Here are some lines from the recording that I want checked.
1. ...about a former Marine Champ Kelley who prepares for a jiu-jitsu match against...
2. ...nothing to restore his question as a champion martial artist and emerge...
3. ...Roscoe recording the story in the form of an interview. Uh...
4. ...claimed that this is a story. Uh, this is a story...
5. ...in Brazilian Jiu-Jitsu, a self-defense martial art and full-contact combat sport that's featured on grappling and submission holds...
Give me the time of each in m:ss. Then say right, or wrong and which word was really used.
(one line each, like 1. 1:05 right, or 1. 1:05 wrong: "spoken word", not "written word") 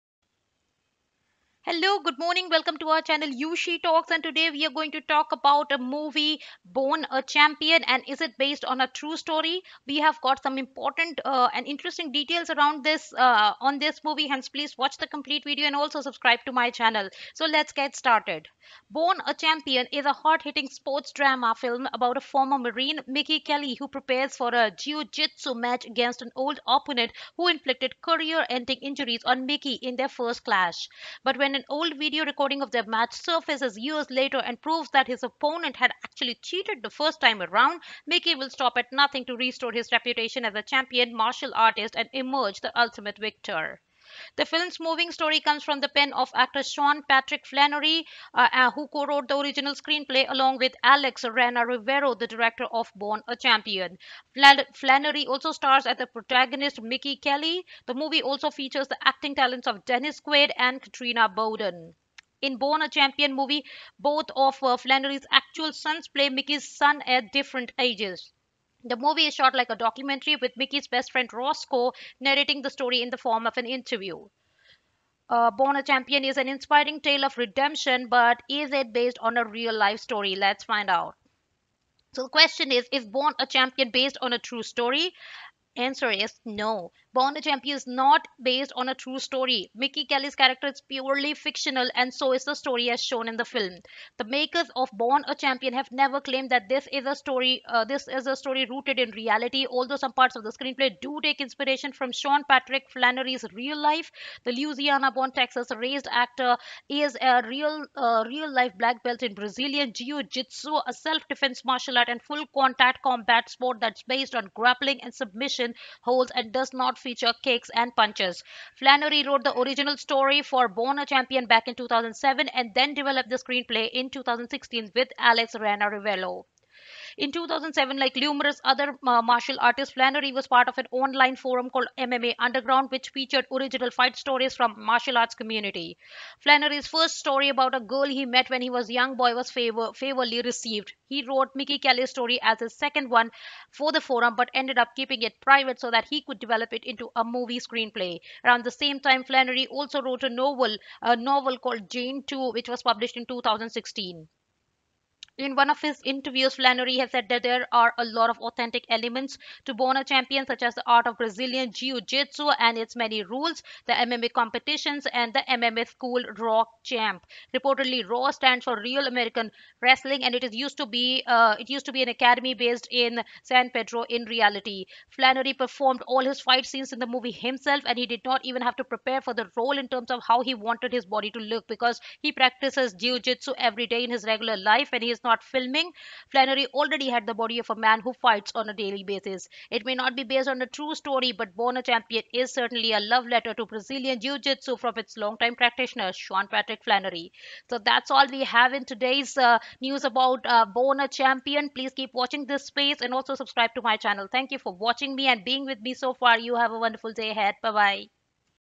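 1. 0:21 wrong: "Mickey", not "Champ"
2. 0:38 wrong: "reputation", not "question"
3. 1:11 wrong: "narrating", not "recording"
4. 1:36 right
5. 1:49 wrong: "based", not "featured".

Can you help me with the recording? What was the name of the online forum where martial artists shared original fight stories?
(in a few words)
MMA Underground.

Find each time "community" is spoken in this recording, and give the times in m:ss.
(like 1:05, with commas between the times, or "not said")
2:15.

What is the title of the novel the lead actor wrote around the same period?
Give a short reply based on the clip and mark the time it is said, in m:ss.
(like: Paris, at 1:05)
Jane 2, at 2:31.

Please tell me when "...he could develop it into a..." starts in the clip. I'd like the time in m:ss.
2:26.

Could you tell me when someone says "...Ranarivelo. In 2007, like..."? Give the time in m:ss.
2:05.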